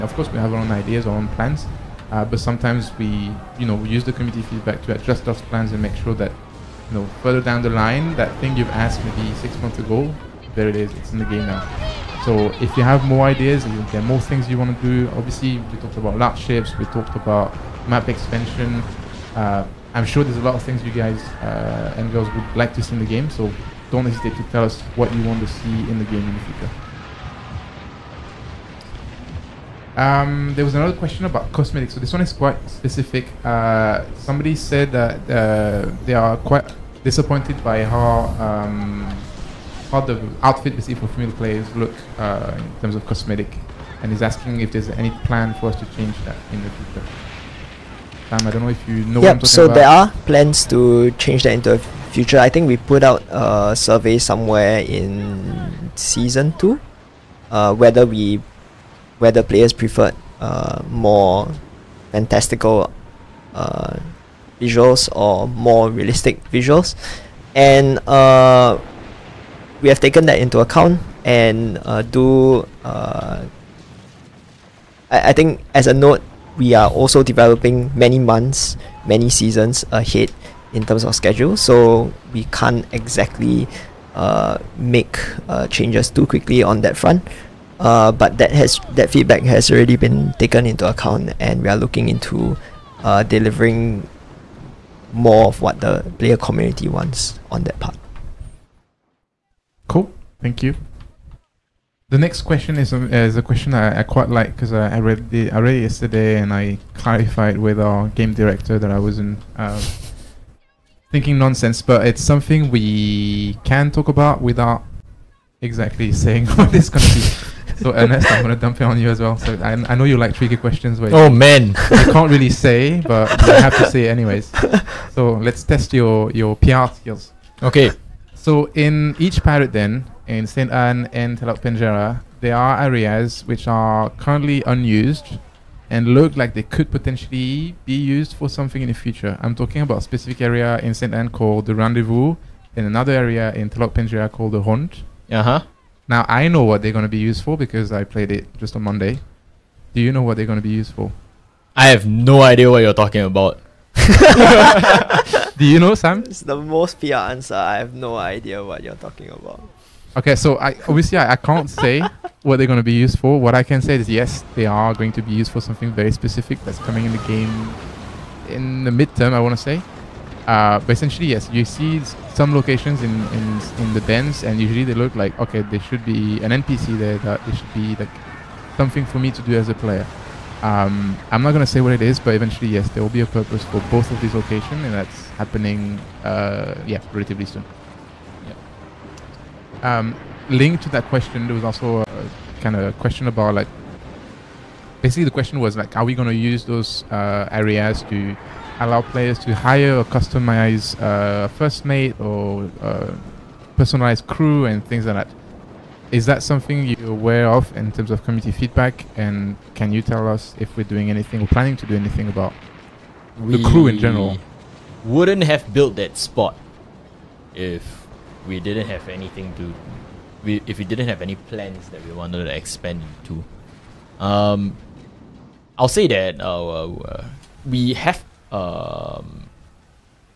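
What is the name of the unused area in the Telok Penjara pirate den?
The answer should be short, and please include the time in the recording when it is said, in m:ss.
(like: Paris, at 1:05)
The Hunt, at 2:24.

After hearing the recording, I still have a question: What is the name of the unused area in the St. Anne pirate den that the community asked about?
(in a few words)
The Rendezvous.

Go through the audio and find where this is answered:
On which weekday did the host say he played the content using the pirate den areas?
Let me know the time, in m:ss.
2:28.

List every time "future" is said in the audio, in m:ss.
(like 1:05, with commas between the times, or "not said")
0:26, 0:46, 0:52, 2:18.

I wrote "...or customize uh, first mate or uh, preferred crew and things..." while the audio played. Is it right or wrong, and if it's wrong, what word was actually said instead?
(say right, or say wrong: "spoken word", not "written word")
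wrong: "personalized", not "preferred".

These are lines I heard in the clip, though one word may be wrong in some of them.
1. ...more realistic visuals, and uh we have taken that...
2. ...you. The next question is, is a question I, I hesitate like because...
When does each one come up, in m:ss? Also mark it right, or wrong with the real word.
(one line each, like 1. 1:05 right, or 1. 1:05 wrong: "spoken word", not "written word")
1. 1:05 right
2. 1:40 wrong: "quite", not "hesitate".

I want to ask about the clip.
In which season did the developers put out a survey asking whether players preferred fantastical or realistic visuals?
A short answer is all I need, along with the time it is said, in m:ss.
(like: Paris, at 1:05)
Season 2, at 0:55.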